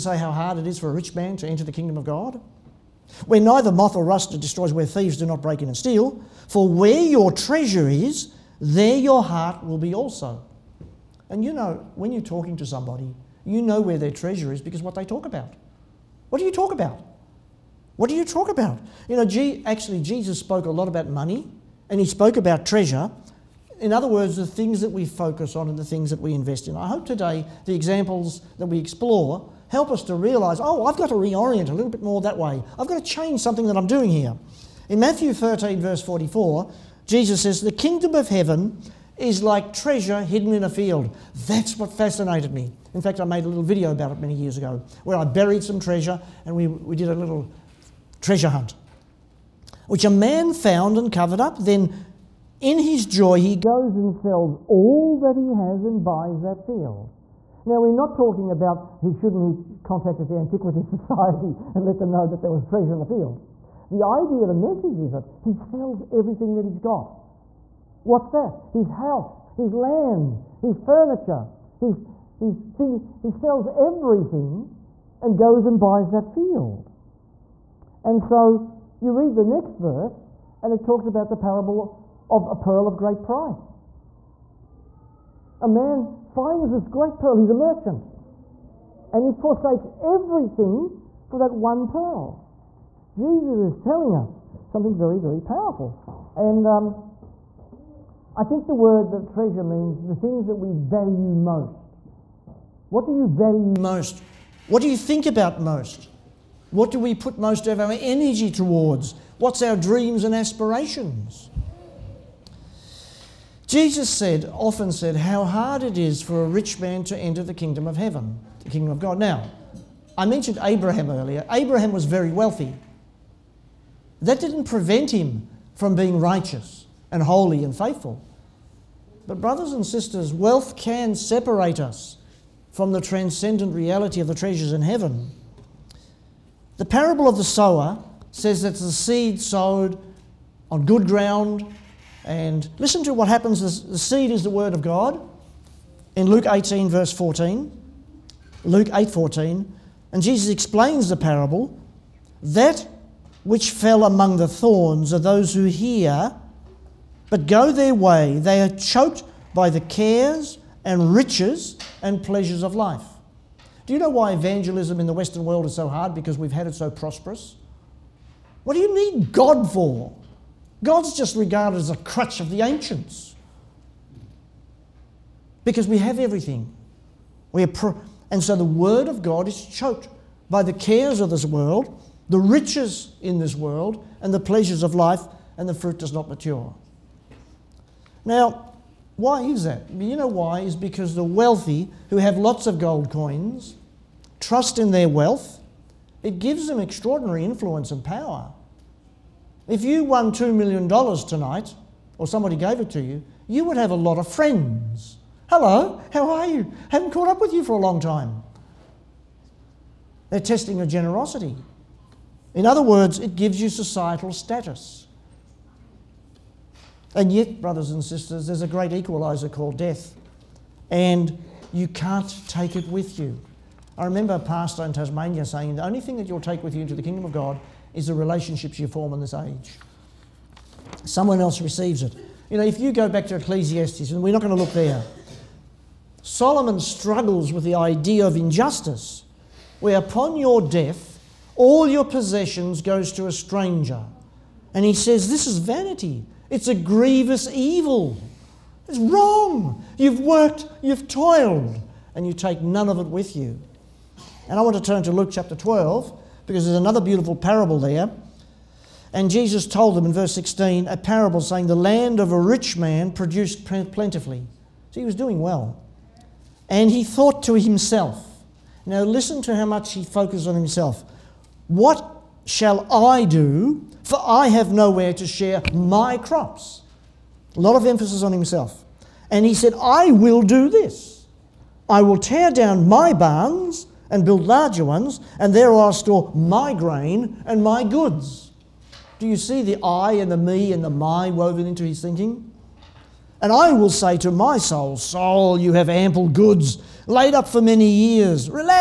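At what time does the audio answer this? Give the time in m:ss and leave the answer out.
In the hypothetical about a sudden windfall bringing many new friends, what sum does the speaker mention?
3:20.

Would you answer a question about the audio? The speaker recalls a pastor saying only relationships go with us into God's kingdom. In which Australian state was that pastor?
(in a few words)
Tasmania.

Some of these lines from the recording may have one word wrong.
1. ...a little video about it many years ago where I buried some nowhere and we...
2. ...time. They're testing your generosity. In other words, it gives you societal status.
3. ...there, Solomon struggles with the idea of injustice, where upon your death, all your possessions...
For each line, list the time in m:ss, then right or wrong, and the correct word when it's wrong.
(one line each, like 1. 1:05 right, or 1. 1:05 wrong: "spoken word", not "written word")
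1. 0:43 wrong: "treasure", not "nowhere"
2. 3:28 right
3. 3:54 right.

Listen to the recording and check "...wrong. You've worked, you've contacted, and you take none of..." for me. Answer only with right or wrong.
wrong.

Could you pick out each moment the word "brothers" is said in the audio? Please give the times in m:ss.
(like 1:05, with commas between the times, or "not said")
2:09, 3:37.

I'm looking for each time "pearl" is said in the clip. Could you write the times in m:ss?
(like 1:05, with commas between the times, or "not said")
1:22, 1:27, 1:31.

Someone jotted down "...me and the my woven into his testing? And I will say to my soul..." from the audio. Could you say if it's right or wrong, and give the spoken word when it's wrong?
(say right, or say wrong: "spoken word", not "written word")
wrong: "thinking", not "testing".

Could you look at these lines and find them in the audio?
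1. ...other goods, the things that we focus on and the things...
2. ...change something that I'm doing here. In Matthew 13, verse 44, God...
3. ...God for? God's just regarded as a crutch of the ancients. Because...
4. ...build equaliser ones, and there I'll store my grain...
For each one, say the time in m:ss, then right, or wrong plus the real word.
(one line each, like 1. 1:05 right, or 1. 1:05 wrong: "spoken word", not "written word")
1. 0:23 wrong: "words", not "goods"
2. 0:33 wrong: "Jesus", not "God"
3. 2:49 right
4. 4:44 wrong: "larger", not "equaliser".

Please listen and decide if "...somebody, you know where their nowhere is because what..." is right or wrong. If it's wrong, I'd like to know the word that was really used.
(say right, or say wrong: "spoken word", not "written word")
wrong: "treasure", not "nowhere".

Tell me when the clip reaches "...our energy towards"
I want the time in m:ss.
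1:47.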